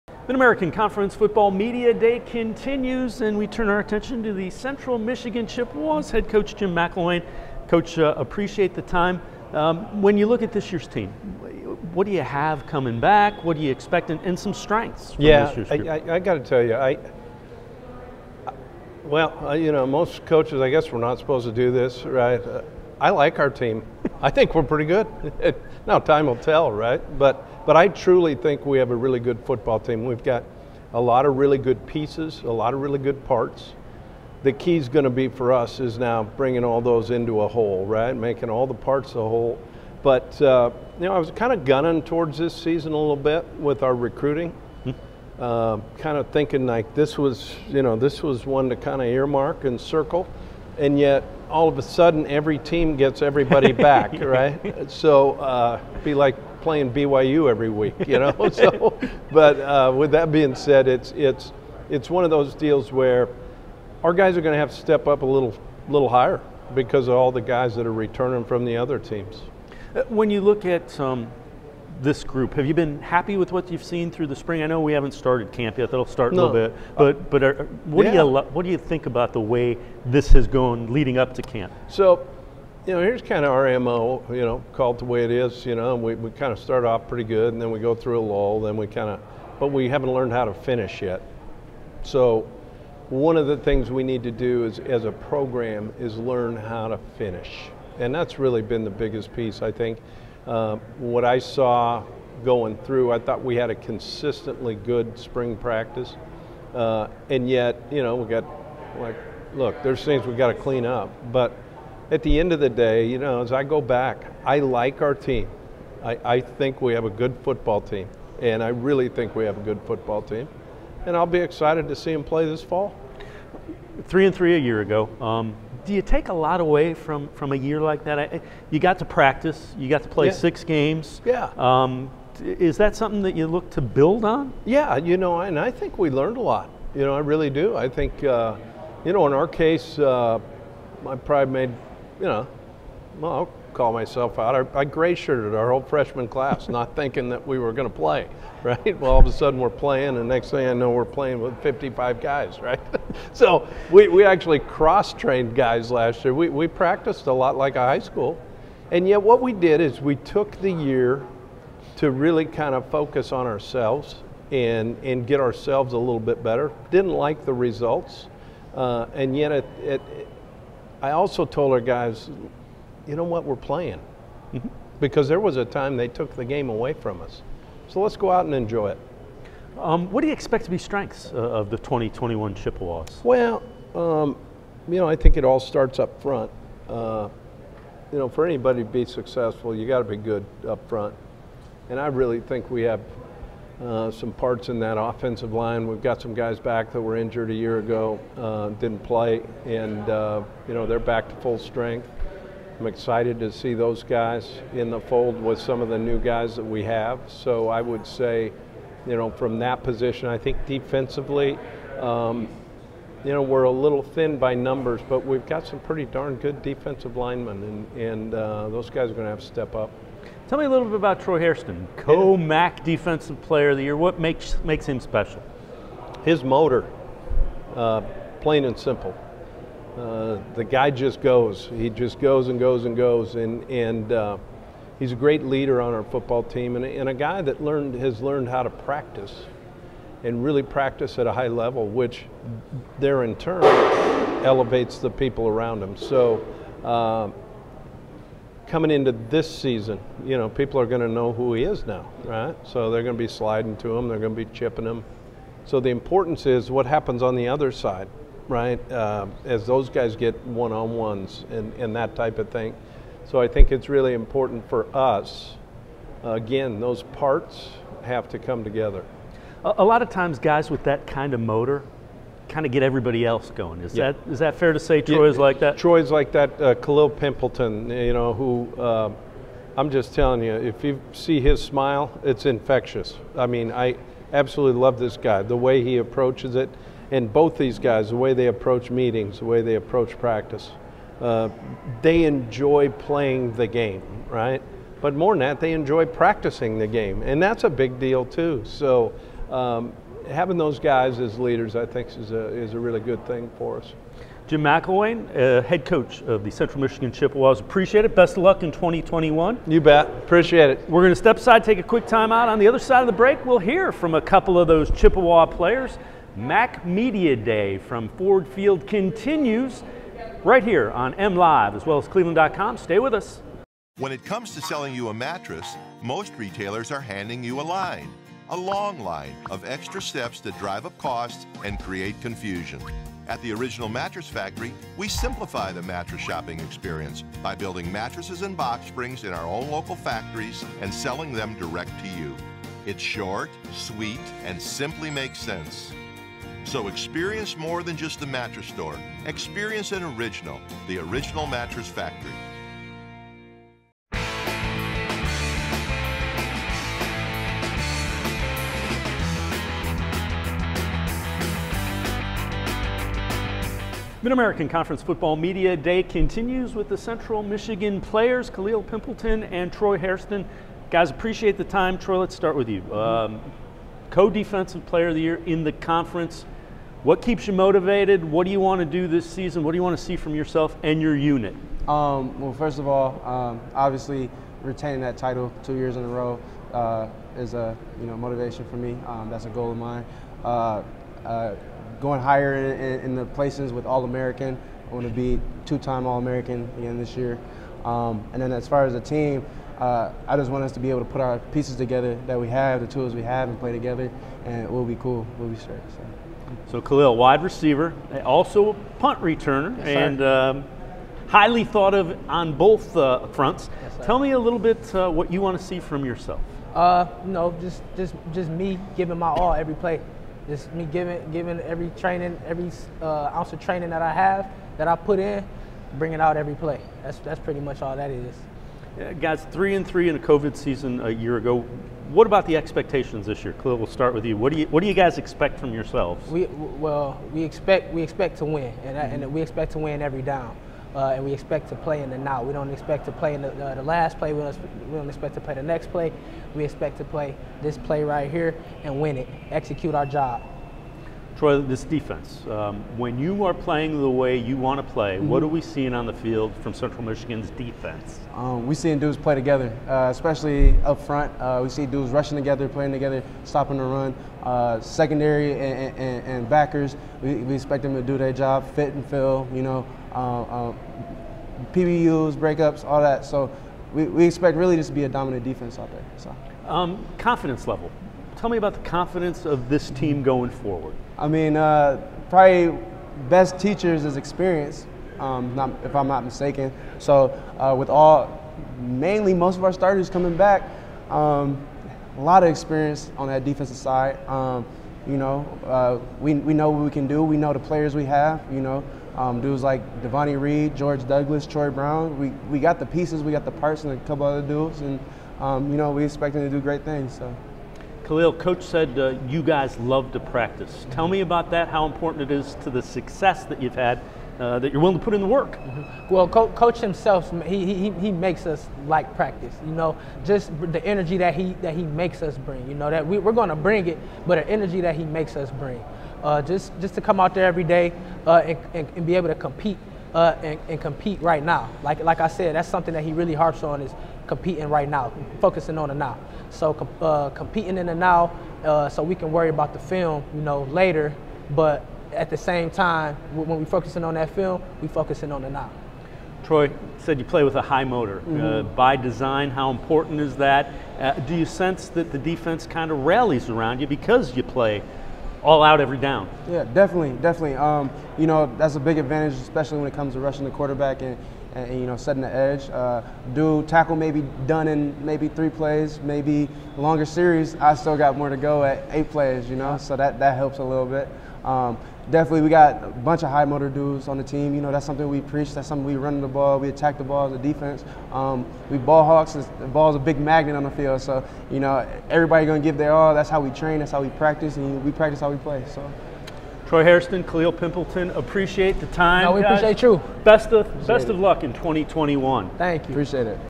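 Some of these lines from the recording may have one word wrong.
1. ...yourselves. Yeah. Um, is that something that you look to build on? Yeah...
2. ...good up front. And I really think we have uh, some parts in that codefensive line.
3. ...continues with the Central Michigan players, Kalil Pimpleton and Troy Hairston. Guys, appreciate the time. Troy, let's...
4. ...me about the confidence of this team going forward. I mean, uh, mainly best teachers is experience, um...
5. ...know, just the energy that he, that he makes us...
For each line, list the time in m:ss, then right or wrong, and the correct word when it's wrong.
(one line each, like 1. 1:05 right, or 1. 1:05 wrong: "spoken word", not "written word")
1. 2:10 wrong: "games", not "yourselves"
2. 3:10 wrong: "offensive", not "codefensive"
3. 6:06 right
4. 7:58 wrong: "probably", not "mainly"
5. 8:39 right.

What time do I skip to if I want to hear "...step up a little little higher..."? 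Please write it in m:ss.
1:04.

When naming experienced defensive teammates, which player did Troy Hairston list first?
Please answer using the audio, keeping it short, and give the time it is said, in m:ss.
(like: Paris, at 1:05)
Devonni Reed, at 8:20.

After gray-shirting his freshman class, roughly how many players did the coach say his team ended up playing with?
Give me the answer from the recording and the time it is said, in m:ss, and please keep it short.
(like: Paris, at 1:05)
55, at 2:31.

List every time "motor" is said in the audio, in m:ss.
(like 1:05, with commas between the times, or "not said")
3:46, 4:31, 9:07, 9:33.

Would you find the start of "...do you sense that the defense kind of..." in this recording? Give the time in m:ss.
9:11.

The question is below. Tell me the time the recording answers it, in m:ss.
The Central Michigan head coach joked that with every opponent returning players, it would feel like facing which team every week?
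0:56.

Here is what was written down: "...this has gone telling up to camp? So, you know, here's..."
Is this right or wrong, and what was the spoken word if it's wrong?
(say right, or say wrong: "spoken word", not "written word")
wrong: "leading", not "telling".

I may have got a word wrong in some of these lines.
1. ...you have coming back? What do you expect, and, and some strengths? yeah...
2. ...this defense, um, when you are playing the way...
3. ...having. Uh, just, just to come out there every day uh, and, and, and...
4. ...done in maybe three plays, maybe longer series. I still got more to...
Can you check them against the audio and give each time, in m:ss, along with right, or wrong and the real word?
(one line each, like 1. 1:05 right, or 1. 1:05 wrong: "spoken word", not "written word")
1. 0:12 right
2. 7:31 right
3. 8:45 wrong: "bring", not "having"
4. 9:24 right.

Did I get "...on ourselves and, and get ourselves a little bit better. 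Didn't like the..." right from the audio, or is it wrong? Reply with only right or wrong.
right.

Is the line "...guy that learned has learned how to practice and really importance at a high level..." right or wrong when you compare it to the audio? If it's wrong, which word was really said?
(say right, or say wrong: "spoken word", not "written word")
wrong: "practice", not "importance".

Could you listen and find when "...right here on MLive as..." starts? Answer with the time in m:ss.
5:20.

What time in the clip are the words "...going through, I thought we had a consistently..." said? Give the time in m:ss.
1:42.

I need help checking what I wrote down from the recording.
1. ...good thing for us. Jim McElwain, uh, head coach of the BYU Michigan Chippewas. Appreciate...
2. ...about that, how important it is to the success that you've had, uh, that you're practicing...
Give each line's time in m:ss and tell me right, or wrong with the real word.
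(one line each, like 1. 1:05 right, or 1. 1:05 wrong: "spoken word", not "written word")
1. 5:02 wrong: "Central", not "BYU"
2. 8:31 wrong: "willing", not "practicing".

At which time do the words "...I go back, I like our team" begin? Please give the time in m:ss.
1:53.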